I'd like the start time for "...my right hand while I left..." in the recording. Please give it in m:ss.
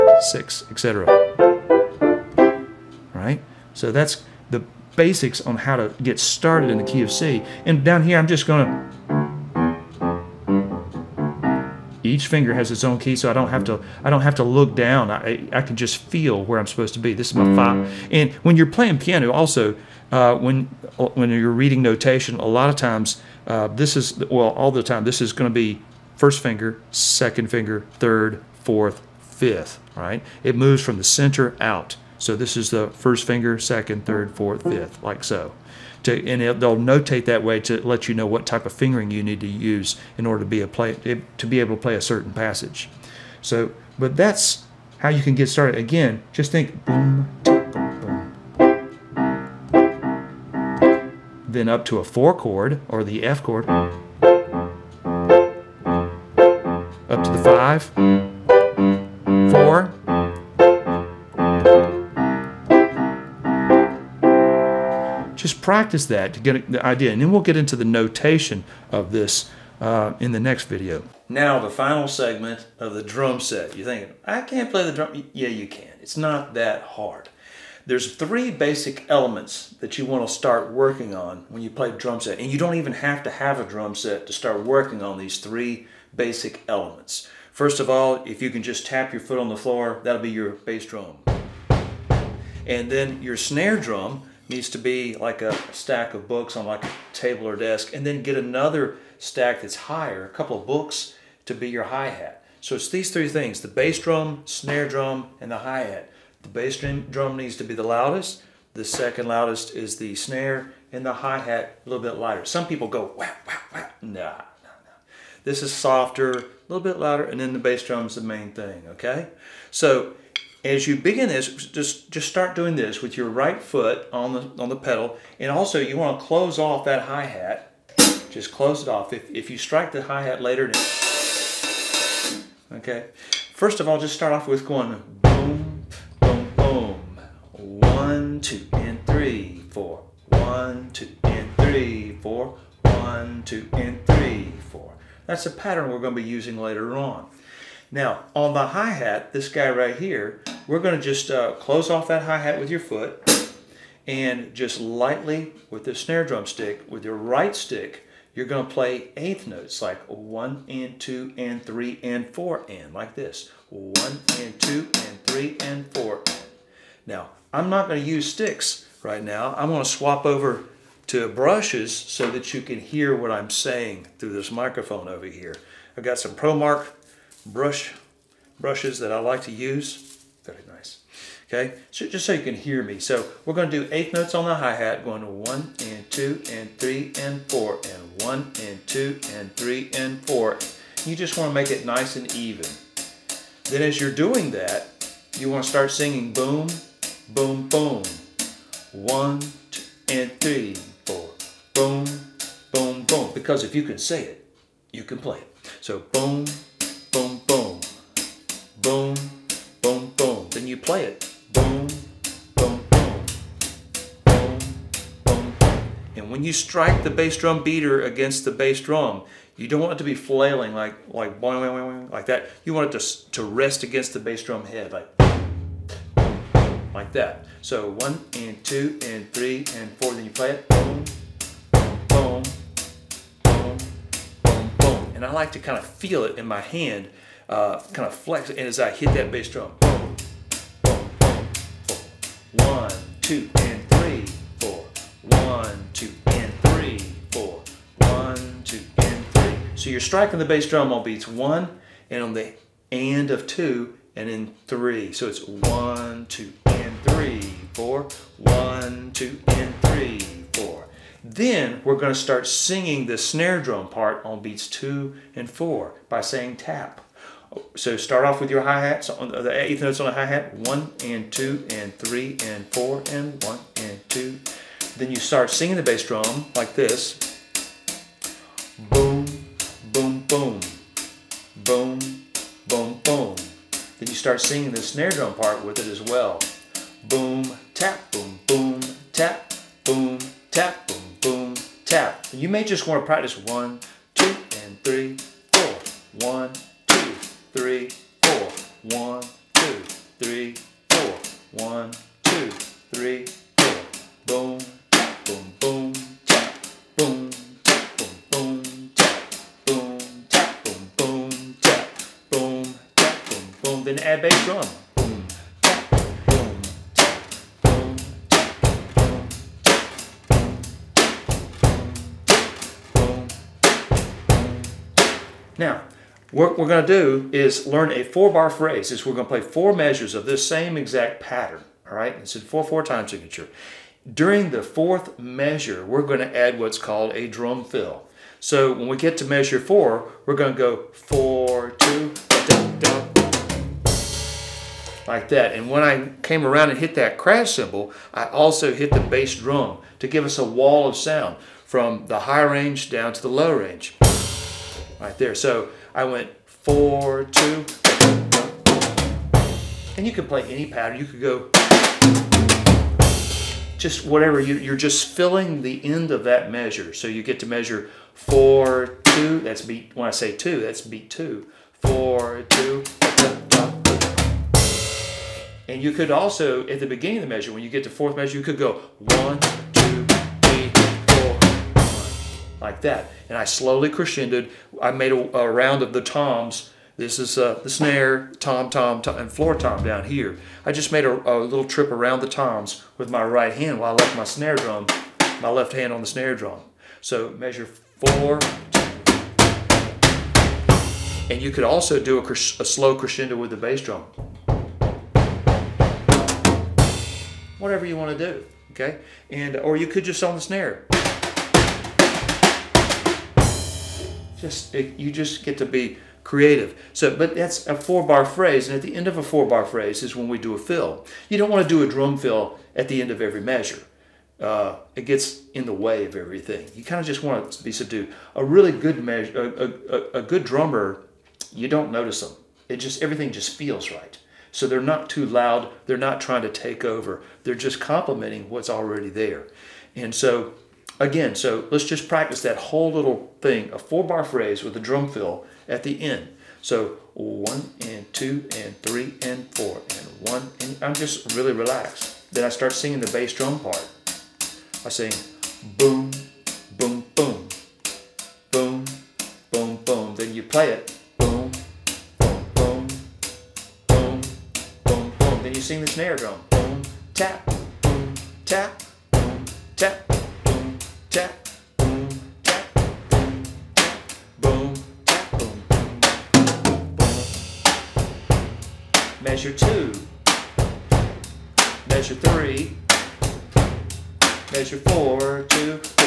6:33.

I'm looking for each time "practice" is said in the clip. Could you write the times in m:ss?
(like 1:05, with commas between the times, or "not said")
1:05, 4:53, 7:22.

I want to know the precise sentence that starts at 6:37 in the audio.
So measure four, and you could also do a, a, slow crescendo with the bass drum.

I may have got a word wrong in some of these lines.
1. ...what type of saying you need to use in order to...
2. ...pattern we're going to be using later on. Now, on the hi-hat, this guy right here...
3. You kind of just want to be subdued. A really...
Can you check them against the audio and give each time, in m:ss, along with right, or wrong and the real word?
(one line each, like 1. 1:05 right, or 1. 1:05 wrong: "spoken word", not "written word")
1. 0:38 wrong: "fingering", not "saying"
2. 2:25 right
3. 7:06 right.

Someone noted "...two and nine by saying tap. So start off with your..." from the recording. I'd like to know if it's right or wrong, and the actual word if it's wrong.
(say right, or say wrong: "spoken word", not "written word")
wrong: "four", not "nine".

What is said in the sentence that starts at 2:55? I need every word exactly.
I've got some ProMark brush brushes that I like to use.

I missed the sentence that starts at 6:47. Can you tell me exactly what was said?
Whatever you want to do, okay?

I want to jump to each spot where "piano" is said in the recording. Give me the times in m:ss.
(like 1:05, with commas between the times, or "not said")
0:18.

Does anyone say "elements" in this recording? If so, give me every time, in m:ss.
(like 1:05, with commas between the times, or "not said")
1:19, 1:26.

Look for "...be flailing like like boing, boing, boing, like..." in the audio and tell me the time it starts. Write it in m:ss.
3:40.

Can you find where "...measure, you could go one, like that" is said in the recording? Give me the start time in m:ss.
6:18.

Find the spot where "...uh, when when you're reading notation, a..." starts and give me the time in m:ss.
0:20.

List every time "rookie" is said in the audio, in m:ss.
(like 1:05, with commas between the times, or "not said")
not said.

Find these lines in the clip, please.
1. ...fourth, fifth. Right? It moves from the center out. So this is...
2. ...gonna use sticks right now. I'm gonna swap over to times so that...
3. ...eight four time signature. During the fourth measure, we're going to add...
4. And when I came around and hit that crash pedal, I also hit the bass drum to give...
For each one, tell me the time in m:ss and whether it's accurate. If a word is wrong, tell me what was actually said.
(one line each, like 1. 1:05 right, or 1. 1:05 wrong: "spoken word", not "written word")
1. 0:28 right
2. 2:47 wrong: "brushes", not "times"
3. 5:32 wrong: "four", not "eight"
4. 5:45 wrong: "cymbal", not "pedal".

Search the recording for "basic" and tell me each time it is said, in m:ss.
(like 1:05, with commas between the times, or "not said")
0:04, 1:18, 1:26.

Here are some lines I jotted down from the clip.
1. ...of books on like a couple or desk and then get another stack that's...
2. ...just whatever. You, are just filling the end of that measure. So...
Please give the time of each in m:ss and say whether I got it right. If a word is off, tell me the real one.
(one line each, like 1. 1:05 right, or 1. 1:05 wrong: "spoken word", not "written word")
1. 1:36 wrong: "table", not "couple"
2. 6:03 right.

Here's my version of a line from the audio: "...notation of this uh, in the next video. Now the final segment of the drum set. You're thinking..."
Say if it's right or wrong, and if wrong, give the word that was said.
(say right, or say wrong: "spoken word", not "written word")
right.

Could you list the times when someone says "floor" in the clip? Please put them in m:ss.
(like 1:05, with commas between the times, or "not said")
1:29, 6:29.